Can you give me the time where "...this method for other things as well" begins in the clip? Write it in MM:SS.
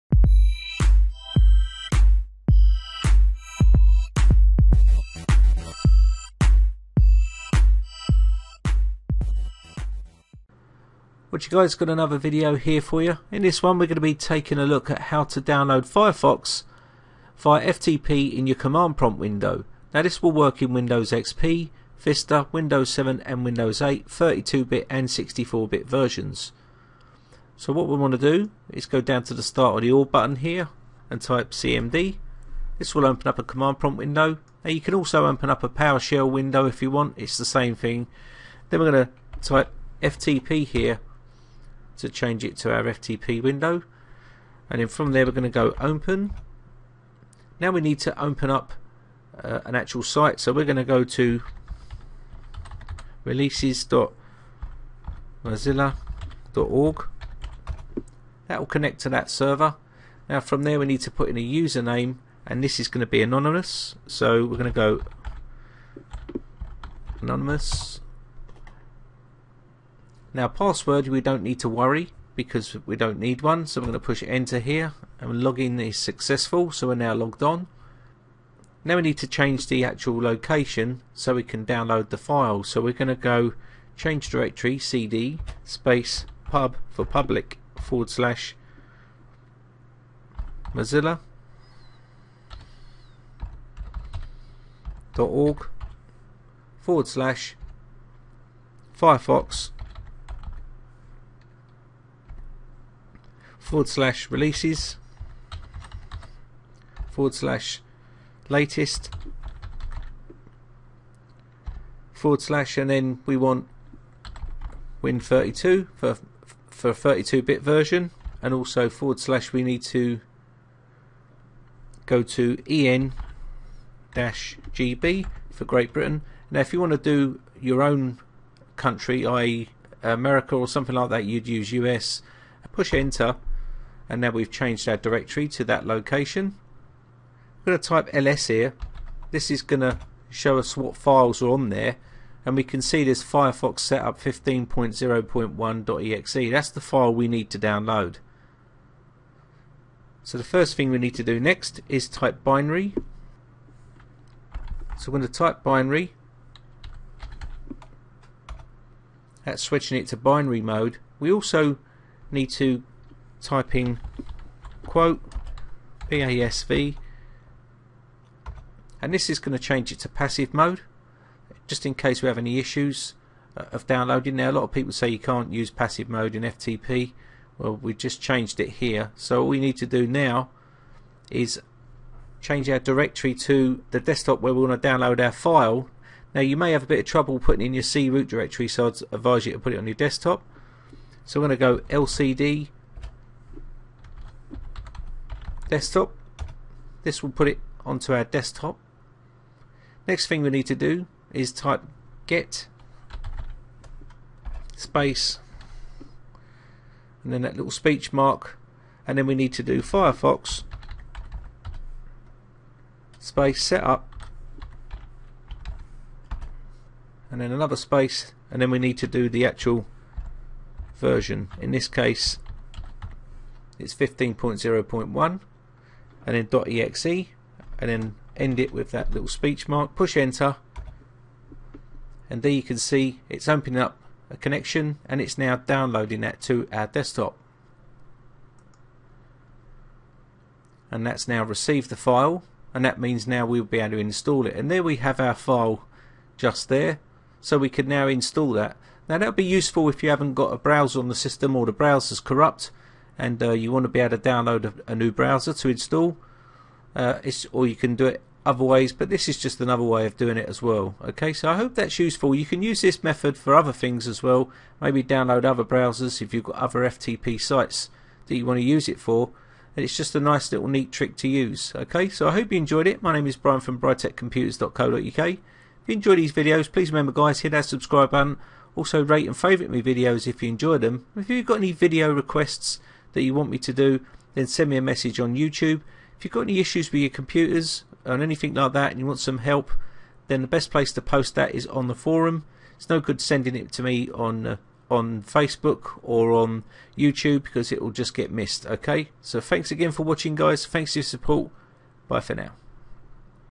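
04:22.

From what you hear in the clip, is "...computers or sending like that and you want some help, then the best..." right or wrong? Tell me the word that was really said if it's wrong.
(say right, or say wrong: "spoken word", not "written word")
wrong: "anything", not "sending".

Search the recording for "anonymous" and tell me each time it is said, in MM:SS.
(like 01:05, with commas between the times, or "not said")
01:03, 01:07.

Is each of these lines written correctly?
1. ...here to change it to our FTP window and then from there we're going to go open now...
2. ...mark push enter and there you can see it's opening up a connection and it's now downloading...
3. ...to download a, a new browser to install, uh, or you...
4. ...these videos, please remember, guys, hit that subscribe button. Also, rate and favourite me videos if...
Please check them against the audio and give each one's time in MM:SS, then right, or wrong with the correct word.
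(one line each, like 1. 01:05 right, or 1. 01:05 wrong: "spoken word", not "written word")
1. 00:40 right
2. 03:49 right
3. 04:14 right
4. 04:36 right.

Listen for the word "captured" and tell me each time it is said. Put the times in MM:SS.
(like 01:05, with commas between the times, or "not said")
not said.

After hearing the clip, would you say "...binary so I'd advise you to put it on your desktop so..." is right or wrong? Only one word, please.
wrong.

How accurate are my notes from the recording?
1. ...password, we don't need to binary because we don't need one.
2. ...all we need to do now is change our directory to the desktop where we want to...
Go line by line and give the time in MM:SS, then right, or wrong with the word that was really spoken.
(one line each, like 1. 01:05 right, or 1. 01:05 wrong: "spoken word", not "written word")
1. 01:10 wrong: "worry", not "binary"
2. 02:59 right.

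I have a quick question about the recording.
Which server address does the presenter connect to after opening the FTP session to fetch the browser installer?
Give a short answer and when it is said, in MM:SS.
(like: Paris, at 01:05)
releases.mozilla.org, at 00:53.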